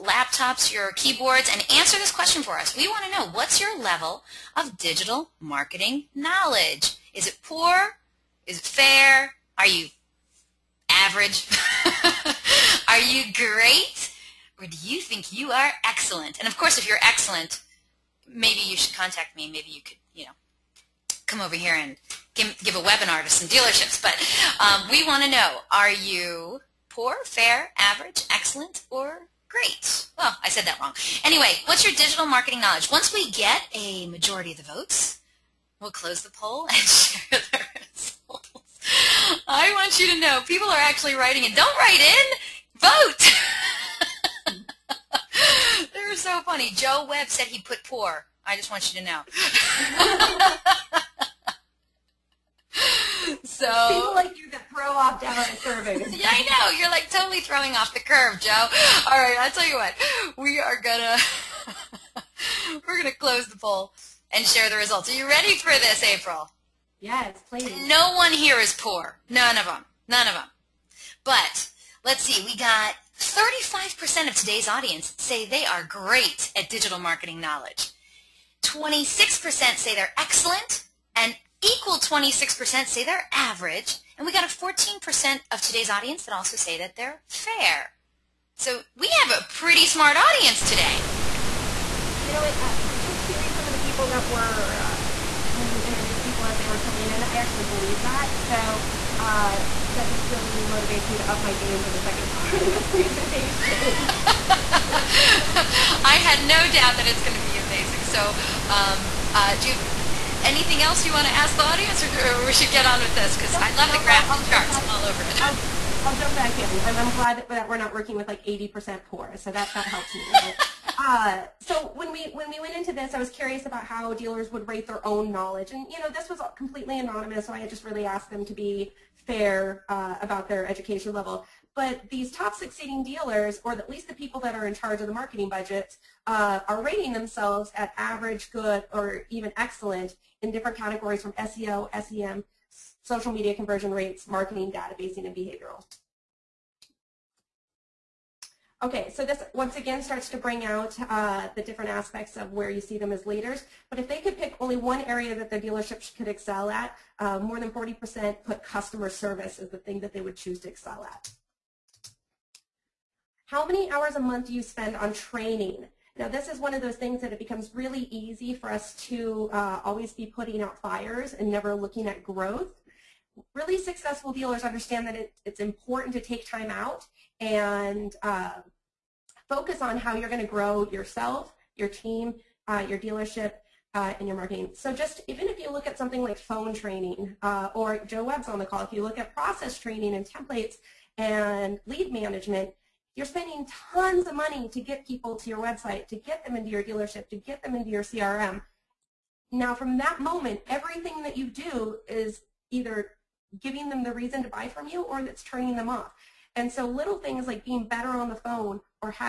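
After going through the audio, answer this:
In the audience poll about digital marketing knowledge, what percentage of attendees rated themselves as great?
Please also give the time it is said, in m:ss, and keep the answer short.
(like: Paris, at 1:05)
35%, at 1:13.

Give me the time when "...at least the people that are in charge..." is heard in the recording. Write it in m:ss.
2:13.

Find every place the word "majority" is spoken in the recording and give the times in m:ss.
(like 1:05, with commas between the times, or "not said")
0:34.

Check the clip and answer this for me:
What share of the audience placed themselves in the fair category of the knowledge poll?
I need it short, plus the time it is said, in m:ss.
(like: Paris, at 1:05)
14%, at 1:24.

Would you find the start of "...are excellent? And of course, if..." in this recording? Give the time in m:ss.
0:15.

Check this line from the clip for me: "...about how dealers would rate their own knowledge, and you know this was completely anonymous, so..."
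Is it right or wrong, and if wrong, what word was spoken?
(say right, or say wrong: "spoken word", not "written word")
right.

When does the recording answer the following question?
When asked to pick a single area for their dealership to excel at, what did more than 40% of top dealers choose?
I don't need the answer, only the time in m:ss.
2:38.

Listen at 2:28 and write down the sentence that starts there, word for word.
Okay, so this once again starts to bring out uh, the different aspects of where you see them as leaders.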